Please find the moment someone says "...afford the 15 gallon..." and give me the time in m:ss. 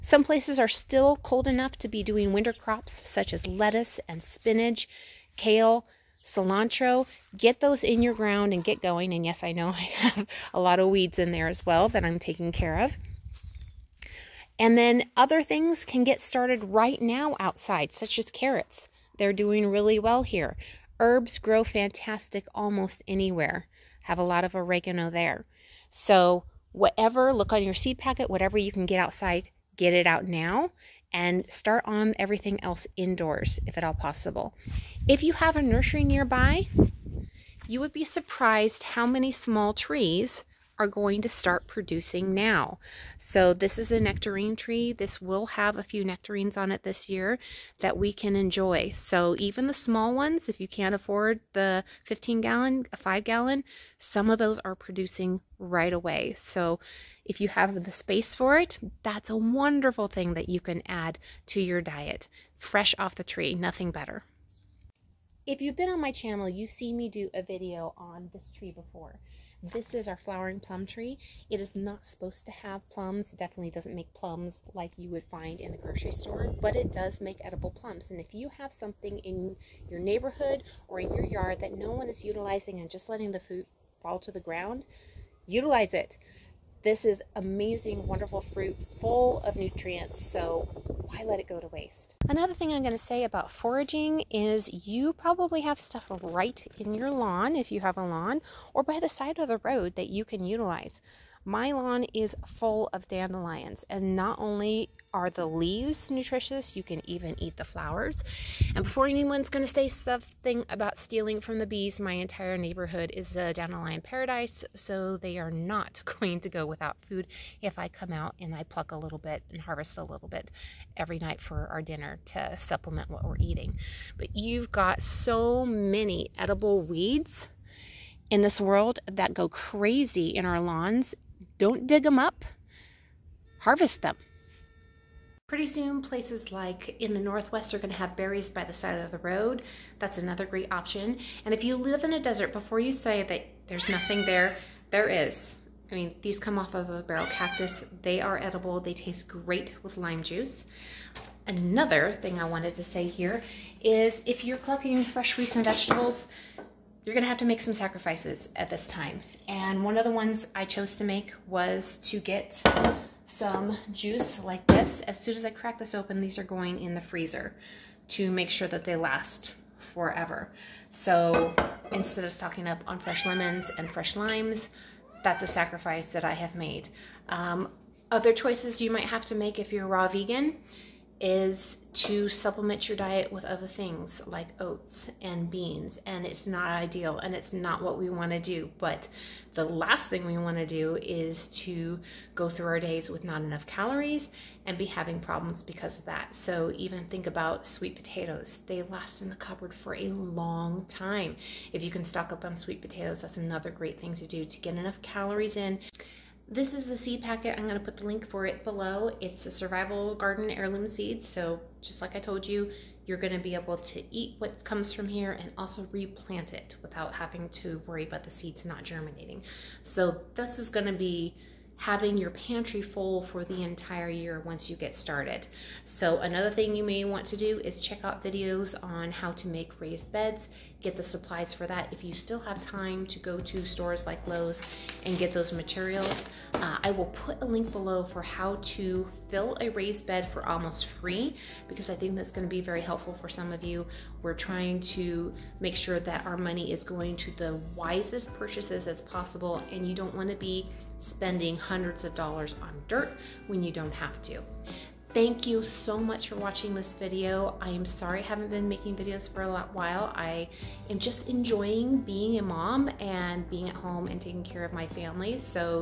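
0:50.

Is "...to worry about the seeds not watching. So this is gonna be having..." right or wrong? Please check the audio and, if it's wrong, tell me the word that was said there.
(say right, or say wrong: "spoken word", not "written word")
wrong: "germinating", not "watching".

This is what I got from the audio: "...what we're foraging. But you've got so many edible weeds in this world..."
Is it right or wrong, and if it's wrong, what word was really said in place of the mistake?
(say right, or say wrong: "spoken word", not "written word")
wrong: "eating", not "foraging".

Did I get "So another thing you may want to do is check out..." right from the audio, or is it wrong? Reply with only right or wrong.
right.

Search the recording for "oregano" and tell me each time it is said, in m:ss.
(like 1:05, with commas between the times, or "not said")
0:24.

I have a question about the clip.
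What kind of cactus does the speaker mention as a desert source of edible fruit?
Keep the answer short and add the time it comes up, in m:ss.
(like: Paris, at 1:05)
Barrel cactus, at 2:27.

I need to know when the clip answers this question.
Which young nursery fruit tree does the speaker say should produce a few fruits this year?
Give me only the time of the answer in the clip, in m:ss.
0:43.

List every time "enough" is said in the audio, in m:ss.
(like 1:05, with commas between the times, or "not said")
0:01, 3:13, 3:24.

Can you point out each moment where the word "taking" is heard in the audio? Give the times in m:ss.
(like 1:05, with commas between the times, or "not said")
0:12, 4:24.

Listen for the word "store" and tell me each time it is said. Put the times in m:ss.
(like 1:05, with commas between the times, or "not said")
1:16, 3:53.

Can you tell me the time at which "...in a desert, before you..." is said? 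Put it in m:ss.
2:22.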